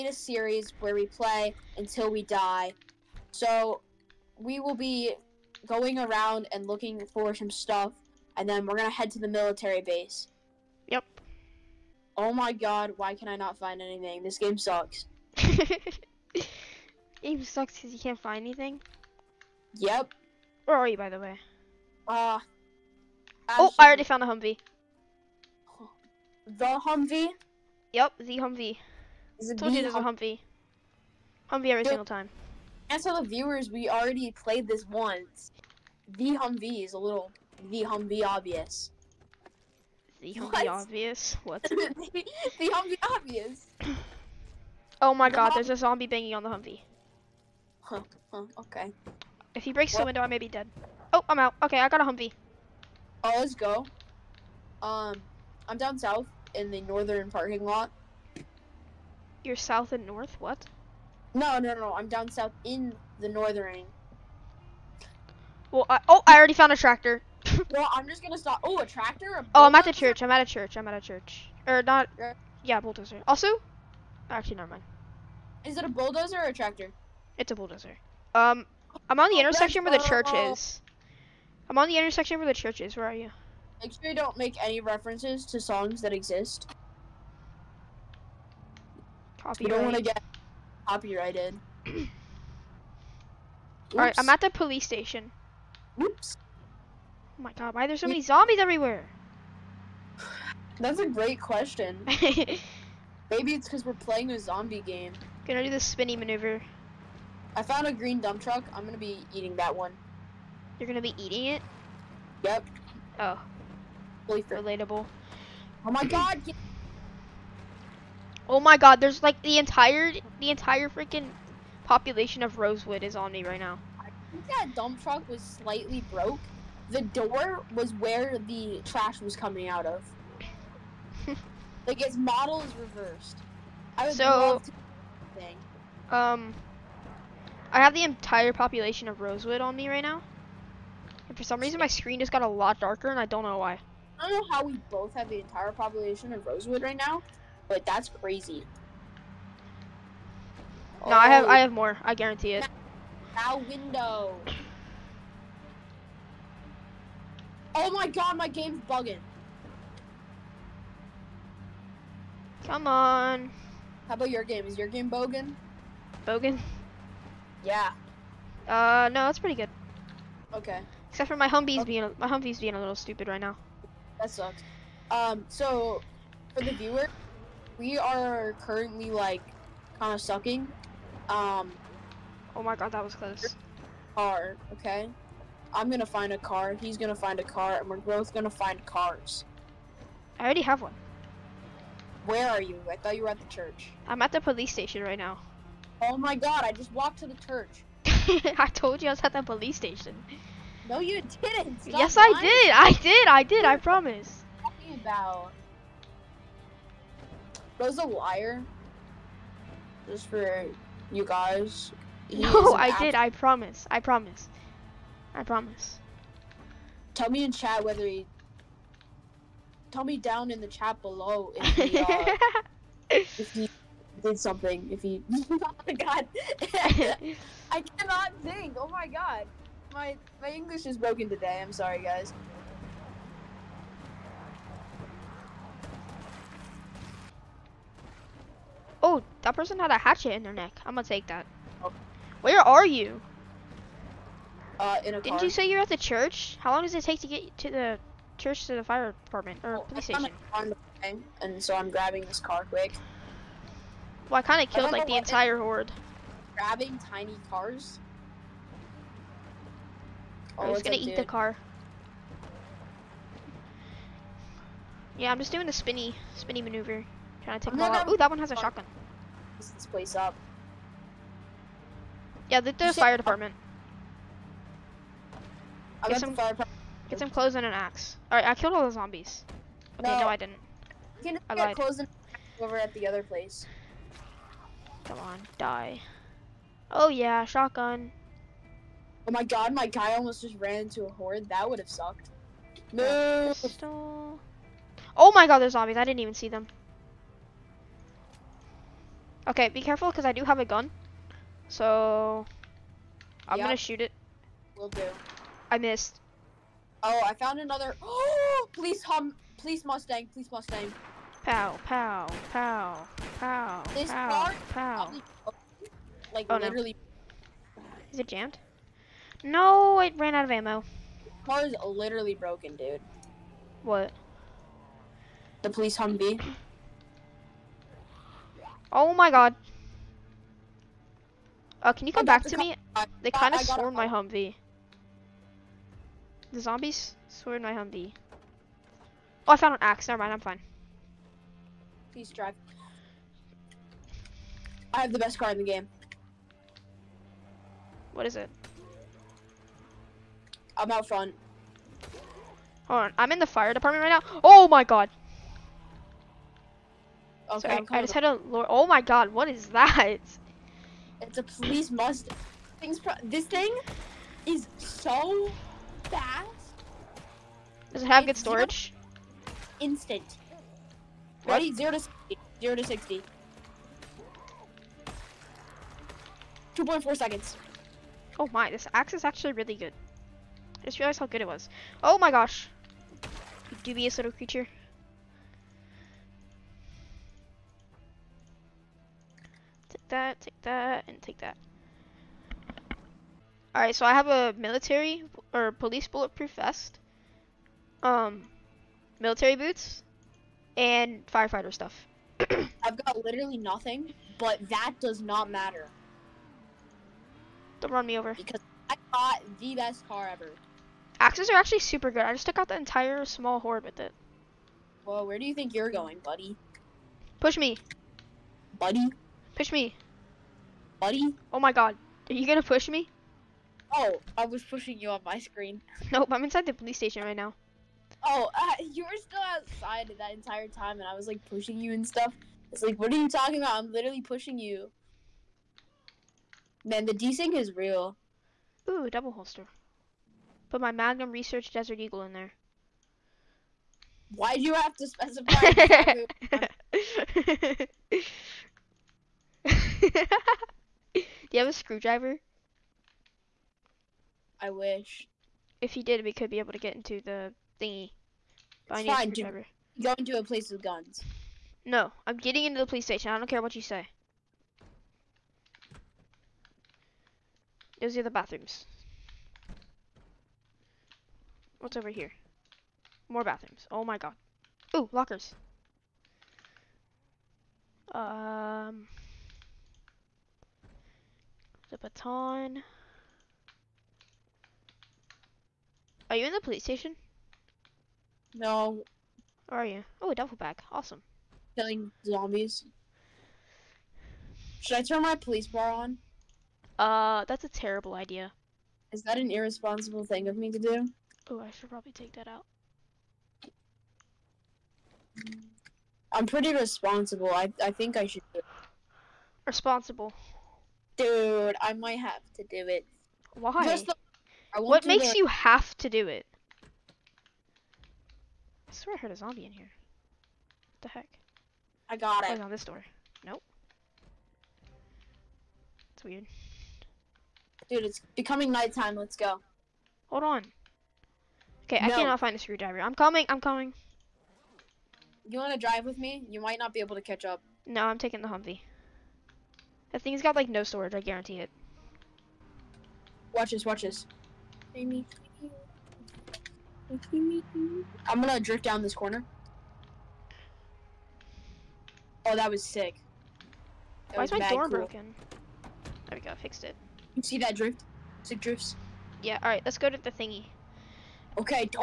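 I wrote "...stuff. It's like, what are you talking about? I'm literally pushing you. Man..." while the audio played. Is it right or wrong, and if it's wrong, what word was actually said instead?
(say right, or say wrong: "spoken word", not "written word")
right.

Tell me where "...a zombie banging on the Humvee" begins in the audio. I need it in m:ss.
0:45.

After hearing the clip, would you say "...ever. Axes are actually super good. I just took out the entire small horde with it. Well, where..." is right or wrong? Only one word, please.
right.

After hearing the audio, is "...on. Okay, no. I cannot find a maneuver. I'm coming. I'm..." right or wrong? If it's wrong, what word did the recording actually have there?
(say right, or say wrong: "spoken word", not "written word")
wrong: "screwdriver", not "maneuver".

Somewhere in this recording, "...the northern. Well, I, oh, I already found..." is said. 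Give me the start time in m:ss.
1:03.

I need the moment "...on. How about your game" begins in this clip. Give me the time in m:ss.
2:42.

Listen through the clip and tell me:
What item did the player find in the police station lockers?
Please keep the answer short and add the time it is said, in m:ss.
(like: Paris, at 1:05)
Baton, at 8:01.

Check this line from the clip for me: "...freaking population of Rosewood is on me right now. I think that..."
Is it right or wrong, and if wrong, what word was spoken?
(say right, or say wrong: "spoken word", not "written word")
right.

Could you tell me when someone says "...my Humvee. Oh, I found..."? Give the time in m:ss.
5:37.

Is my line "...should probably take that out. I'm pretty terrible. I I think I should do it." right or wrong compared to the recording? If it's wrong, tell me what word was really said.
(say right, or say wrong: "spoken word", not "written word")
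wrong: "responsible", not "terrible".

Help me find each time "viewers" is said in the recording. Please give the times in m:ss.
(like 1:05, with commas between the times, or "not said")
0:33, 2:56.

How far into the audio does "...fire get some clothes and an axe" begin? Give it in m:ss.
4:36.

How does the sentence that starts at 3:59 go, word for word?
Oh, that person had a hatchet in their neck.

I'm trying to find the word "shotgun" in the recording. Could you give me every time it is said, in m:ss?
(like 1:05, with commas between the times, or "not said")
4:28, 4:47.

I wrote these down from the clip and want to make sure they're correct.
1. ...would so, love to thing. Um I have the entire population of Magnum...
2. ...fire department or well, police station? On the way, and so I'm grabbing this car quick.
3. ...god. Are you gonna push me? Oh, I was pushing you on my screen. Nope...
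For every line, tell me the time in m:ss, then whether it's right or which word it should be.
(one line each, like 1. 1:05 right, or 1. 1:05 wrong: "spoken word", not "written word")
1. 2:14 wrong: "Rosewood", not "Magnum"
2. 4:08 right
3. 7:01 right.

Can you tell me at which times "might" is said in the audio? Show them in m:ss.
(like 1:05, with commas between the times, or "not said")
8:31, 8:56.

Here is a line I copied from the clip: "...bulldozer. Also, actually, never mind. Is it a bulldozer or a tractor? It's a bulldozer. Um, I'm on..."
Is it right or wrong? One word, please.
right.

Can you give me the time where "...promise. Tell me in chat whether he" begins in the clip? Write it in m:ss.
3:35.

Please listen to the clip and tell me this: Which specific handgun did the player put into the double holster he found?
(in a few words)
Desert Eagle.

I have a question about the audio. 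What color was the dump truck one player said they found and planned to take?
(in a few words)
Green.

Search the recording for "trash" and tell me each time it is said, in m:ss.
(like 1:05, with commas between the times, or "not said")
2:08.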